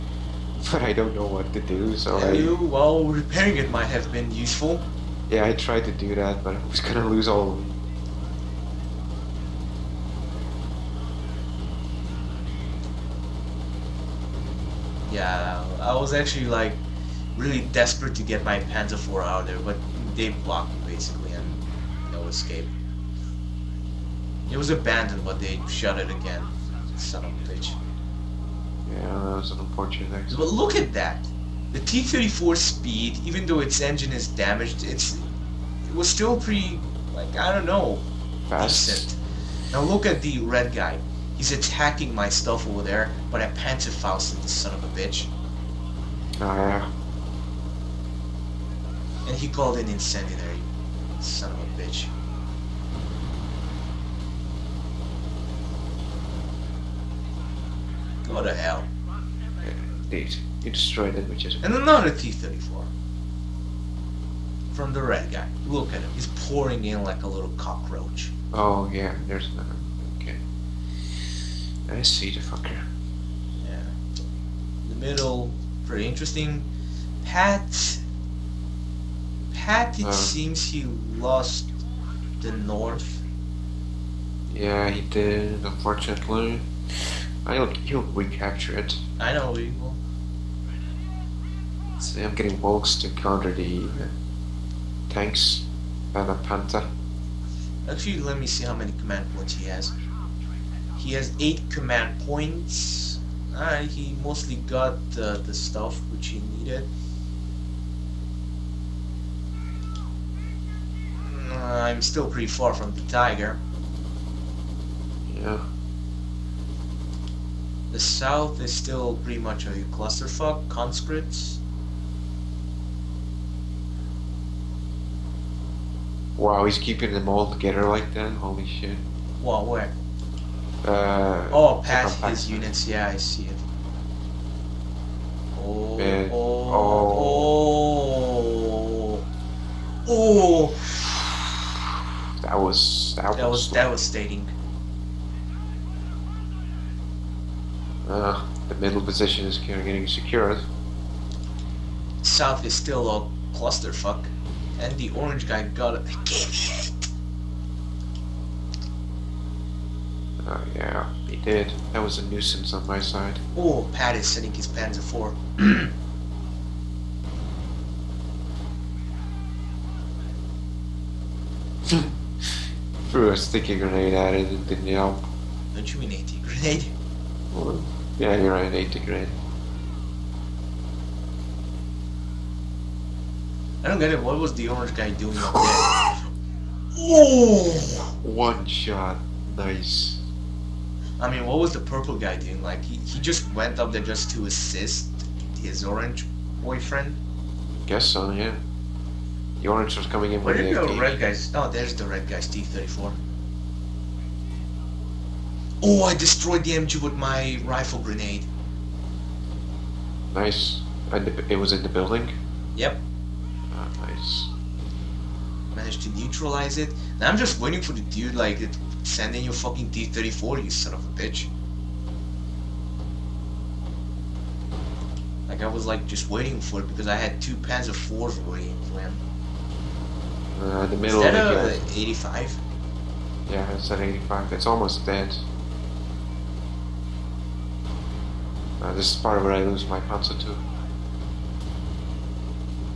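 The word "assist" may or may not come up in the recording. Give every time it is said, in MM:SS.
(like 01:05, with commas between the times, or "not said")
03:14.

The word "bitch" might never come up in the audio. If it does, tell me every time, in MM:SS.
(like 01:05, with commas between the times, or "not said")
00:27, 00:44, 00:51, 03:41.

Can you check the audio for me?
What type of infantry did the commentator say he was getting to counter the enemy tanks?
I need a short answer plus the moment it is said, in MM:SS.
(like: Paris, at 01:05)
Volks, at 01:32.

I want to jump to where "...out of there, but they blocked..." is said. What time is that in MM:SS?
00:19.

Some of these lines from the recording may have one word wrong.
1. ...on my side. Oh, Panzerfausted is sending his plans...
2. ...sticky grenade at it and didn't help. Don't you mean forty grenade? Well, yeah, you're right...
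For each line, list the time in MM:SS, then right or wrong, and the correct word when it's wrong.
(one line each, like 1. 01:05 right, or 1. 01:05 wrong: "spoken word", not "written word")
1. 02:42 wrong: "Pat", not "Panzerfausted"
2. 02:53 wrong: "eighty", not "forty".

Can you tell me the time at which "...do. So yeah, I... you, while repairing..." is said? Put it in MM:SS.
00:01.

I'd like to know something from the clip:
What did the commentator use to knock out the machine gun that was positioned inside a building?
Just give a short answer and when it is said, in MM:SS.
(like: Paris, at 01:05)
Rifle grenade, at 03:27.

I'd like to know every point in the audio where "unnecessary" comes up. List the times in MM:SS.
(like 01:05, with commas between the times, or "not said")
not said.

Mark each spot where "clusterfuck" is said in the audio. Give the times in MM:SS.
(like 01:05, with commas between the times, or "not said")
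01:59, 02:33.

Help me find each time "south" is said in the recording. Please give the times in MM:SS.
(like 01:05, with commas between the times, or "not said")
01:57, 02:32.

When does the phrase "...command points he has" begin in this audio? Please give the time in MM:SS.
01:38.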